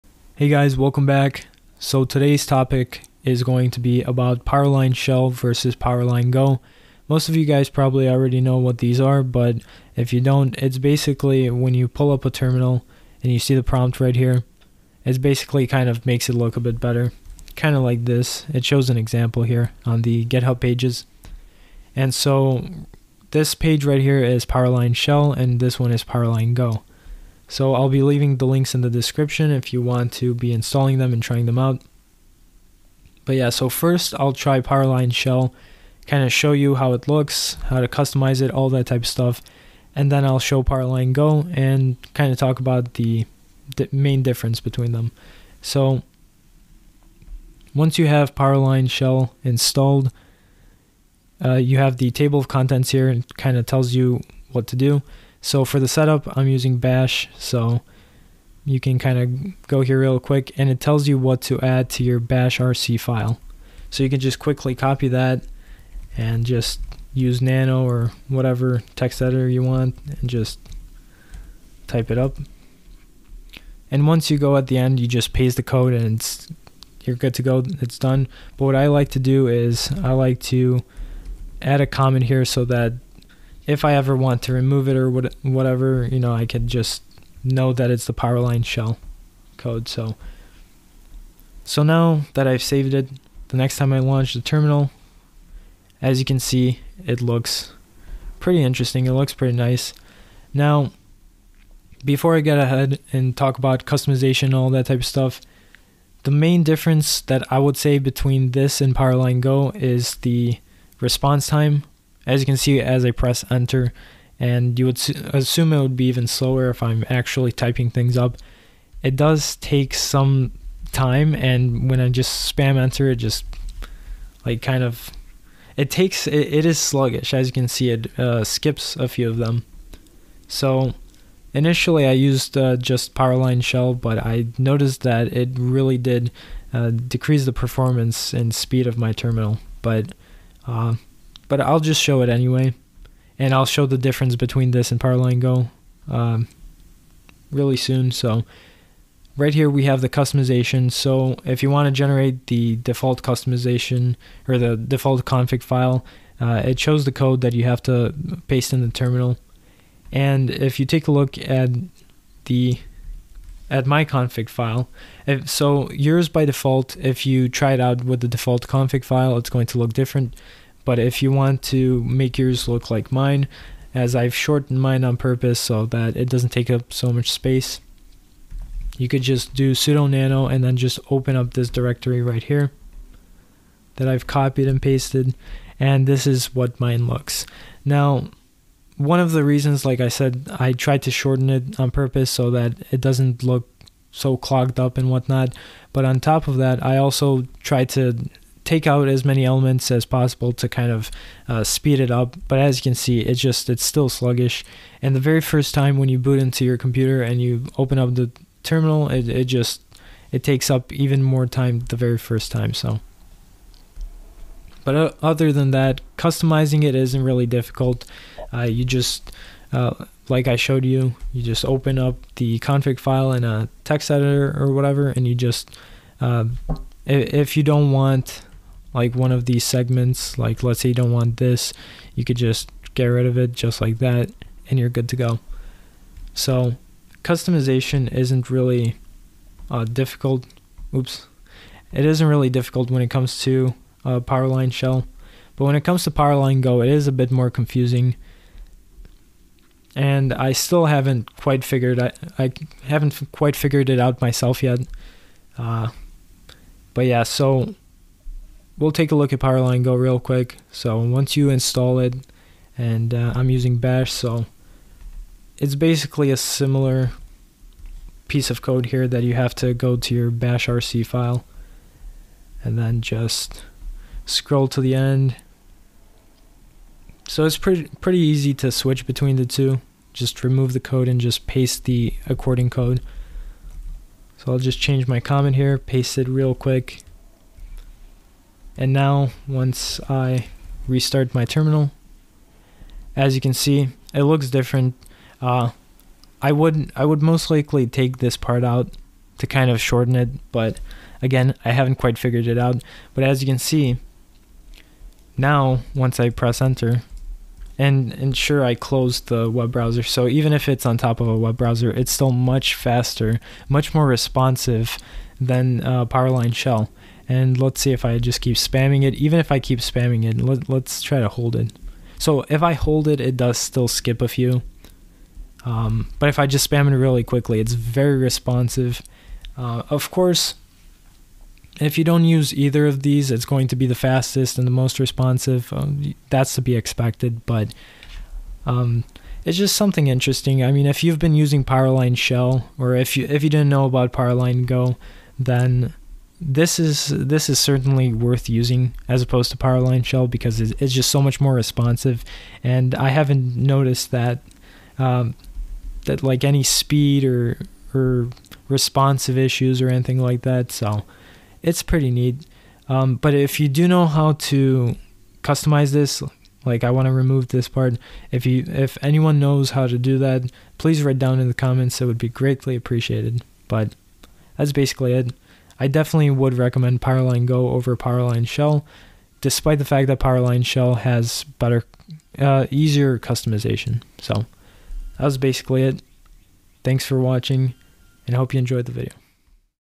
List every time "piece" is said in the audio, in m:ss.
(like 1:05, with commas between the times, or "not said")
4:28.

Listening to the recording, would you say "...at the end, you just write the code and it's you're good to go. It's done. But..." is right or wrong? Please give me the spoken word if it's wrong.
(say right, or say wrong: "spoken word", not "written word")
wrong: "paste", not "write".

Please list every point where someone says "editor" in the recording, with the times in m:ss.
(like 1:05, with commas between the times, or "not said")
1:09, 3:44.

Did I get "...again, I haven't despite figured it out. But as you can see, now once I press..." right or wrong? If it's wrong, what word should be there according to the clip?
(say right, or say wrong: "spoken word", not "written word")
wrong: "quite", not "despite".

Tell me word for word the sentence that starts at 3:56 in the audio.
So customization isn't really uh, difficult.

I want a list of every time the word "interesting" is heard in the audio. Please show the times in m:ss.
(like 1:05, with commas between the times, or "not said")
1:38, 5:40.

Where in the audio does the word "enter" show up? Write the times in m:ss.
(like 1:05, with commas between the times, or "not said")
1:53, 2:02, 5:06.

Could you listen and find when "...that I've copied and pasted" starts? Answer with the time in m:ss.
3:03.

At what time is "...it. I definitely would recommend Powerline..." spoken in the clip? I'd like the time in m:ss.
6:15.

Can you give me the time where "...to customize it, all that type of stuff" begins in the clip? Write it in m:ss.
0:37.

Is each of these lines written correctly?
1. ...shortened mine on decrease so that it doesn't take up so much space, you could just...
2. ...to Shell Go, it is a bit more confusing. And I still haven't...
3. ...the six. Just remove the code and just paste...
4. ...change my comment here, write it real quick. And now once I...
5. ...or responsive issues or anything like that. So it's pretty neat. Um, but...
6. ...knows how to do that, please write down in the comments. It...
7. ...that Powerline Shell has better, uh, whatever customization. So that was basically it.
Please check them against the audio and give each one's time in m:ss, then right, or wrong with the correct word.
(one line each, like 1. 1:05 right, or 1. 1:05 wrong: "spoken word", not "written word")
1. 2:54 wrong: "purpose", not "decrease"
2. 4:06 wrong: "Powerline", not "Shell"
3. 4:39 wrong: "two", not "six"
4. 4:44 wrong: "paste", not "write"
5. 5:57 right
6. 6:09 right
7. 6:20 wrong: "easier", not "whatever".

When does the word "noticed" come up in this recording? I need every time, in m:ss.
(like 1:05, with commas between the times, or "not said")
2:14, 5:53.